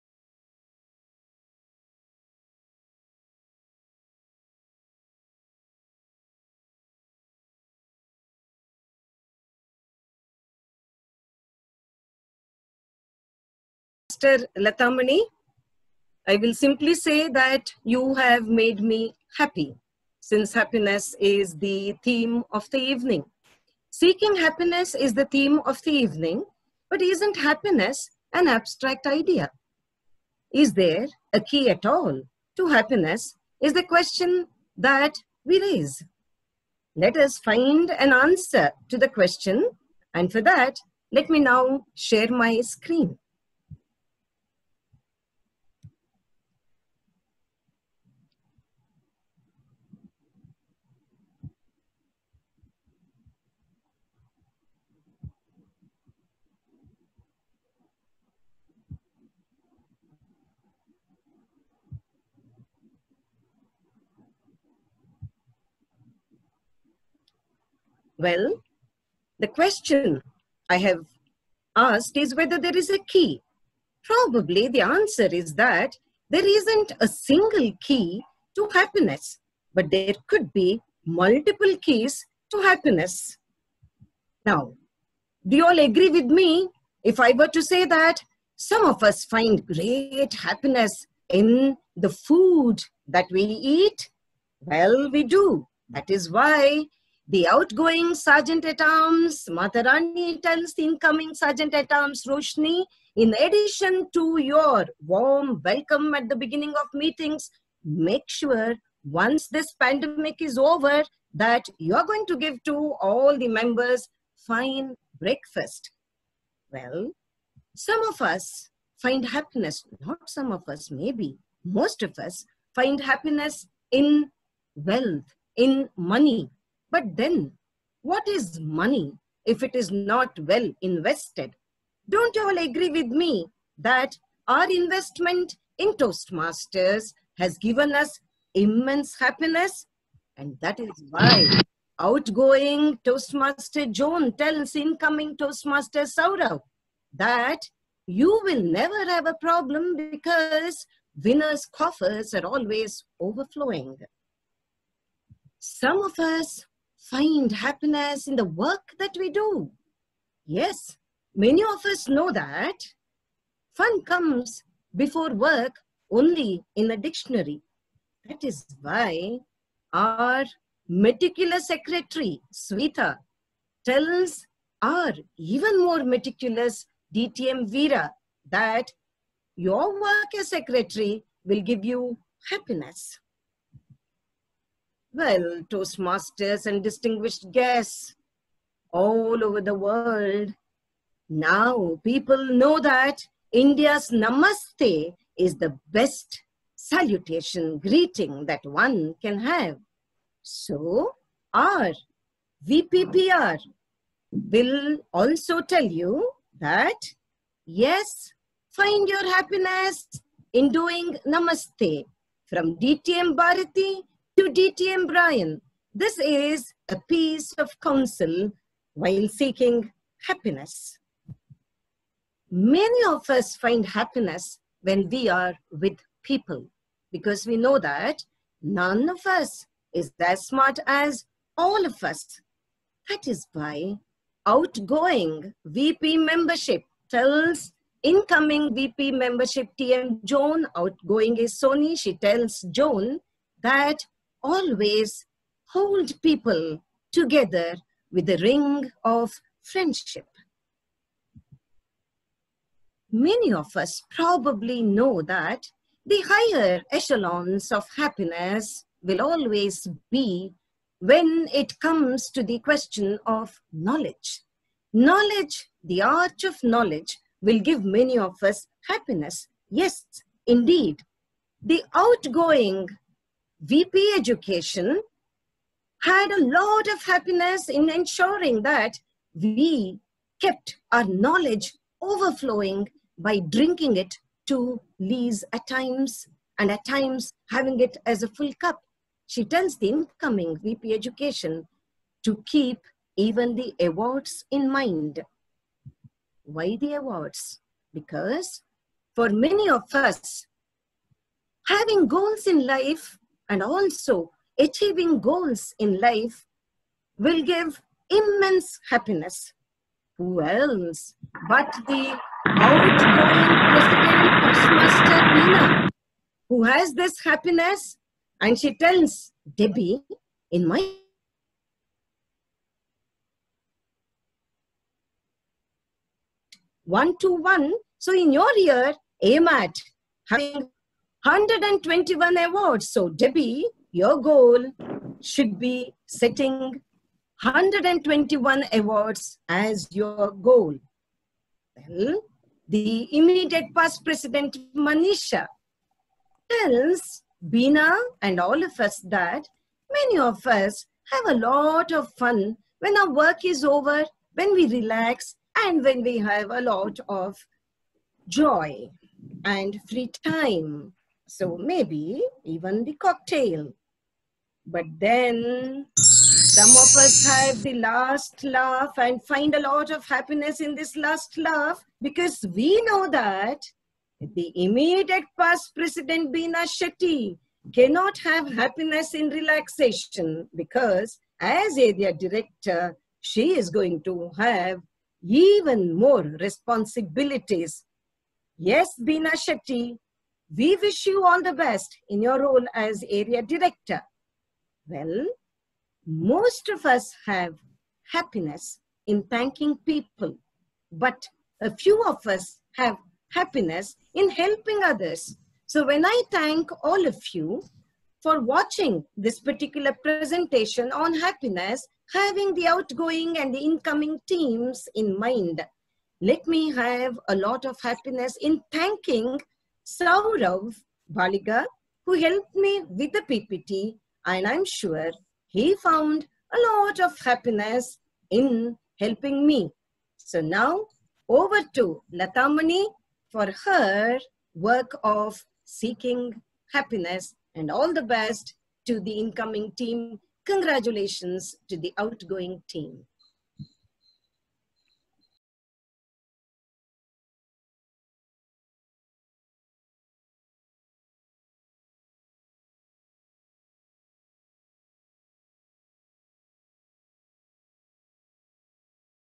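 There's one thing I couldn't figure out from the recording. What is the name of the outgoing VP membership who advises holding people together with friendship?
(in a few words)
Sony.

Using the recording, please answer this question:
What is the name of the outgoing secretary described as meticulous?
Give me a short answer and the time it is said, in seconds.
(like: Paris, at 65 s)
Sweta, at 172 s.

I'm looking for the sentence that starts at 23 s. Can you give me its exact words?
Seeking happiness is the theme of the evening, but isn't happiness an abstract idea?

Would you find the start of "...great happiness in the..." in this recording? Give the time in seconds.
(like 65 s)
89 s.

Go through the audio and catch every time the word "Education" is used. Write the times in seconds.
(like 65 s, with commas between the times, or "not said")
274 s, 290 s.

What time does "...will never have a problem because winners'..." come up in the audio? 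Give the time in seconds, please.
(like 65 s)
148 s.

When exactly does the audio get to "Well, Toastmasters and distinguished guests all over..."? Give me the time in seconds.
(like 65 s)
185 s.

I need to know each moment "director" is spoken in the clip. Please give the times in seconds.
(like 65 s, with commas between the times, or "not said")
382 s, 393 s.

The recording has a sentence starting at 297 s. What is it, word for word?
Because for many of us, having goals in life and also achieving goals in life will give immense happiness.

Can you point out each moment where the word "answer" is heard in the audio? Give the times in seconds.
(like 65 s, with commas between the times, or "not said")
38 s, 74 s.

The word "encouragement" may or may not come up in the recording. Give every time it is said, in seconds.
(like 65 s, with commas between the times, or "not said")
not said.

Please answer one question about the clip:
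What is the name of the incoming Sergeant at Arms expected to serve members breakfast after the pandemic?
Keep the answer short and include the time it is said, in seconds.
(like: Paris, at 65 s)
Roshni, at 102 s.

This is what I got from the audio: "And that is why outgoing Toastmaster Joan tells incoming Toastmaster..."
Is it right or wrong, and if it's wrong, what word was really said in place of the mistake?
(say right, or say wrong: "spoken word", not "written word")
right.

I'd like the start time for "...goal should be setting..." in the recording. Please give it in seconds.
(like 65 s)
334 s.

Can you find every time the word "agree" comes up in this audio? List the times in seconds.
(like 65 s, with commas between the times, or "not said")
85 s, 132 s.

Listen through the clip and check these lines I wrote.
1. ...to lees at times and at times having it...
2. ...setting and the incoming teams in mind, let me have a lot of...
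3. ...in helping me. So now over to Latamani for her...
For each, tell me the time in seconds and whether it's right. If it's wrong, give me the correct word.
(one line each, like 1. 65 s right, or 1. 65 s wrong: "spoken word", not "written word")
1. 284 s right
2. 412 s wrong: "outgoing", not "setting"
3. 428 s right.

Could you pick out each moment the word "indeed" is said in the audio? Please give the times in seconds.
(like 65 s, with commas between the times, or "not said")
270 s.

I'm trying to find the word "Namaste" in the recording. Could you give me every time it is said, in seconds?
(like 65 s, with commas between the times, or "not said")
194 s, 211 s.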